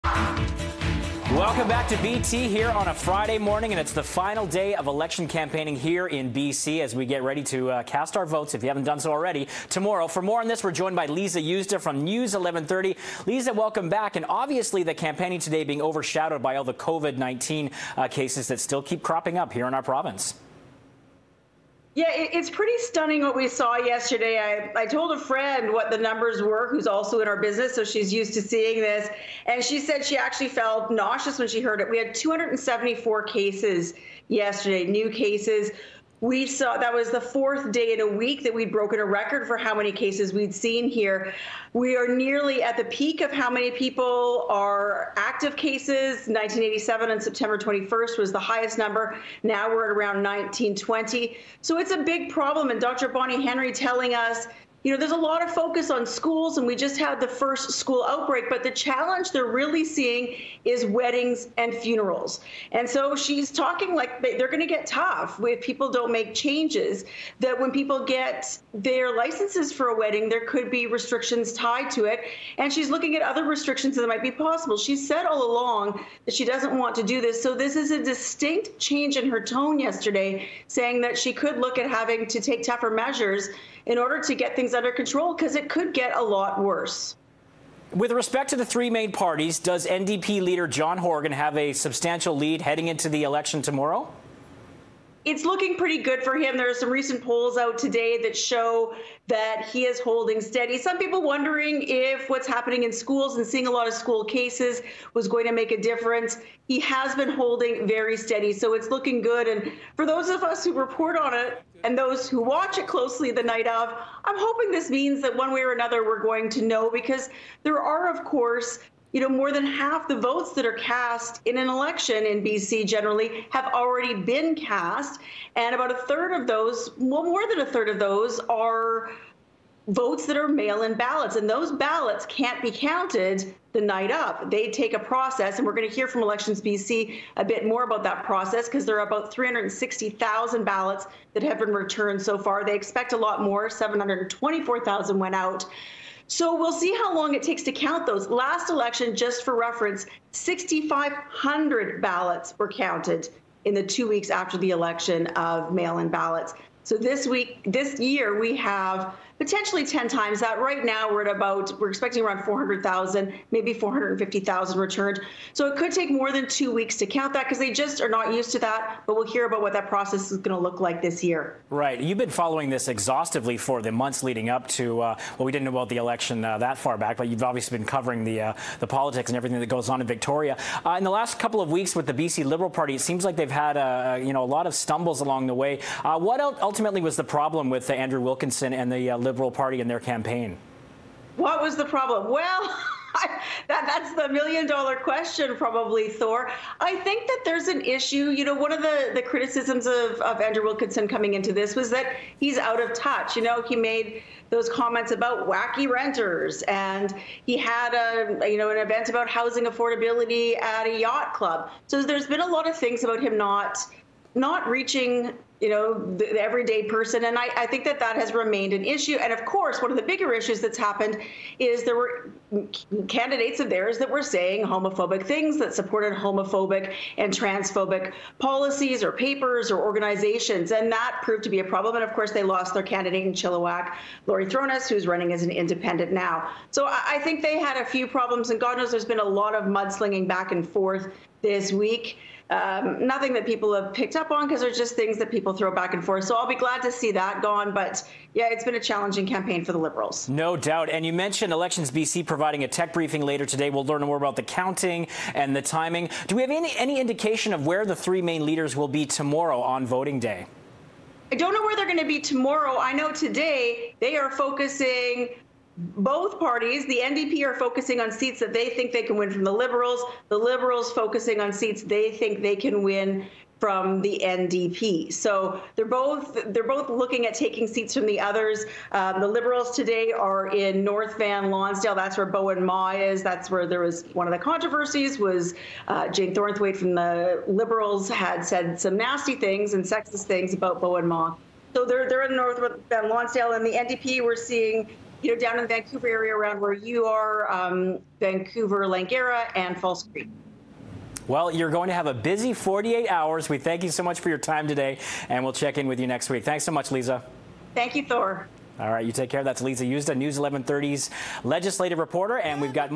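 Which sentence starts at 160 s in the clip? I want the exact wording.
Right now, we're at about, we're expecting around 400,000, maybe 450,000 returned.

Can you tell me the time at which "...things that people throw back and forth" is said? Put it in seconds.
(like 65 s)
244 s.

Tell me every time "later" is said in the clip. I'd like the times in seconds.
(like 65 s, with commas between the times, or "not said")
253 s.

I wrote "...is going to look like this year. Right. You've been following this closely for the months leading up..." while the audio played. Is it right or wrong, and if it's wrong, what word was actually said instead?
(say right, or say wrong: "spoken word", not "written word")
wrong: "exhaustively", not "closely".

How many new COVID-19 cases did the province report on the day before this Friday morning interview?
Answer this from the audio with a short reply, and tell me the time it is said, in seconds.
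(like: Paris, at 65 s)
274, at 32 s.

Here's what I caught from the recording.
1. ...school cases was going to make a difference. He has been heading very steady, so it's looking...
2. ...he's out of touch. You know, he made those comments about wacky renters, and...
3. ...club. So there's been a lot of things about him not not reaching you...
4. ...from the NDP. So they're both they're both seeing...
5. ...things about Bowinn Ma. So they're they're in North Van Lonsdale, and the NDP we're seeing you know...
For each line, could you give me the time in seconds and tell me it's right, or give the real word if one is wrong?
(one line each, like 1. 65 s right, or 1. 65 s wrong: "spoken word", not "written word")
1. 103 s wrong: "holding", not "heading"
2. 202 s right
3. 211 s right
4. 273 s wrong: "looking", not "seeing"
5. 290 s right.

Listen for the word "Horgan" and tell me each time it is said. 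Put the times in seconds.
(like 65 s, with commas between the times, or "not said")
90 s.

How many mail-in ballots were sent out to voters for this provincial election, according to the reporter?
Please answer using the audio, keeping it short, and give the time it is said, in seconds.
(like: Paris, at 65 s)
724,000, at 143 s.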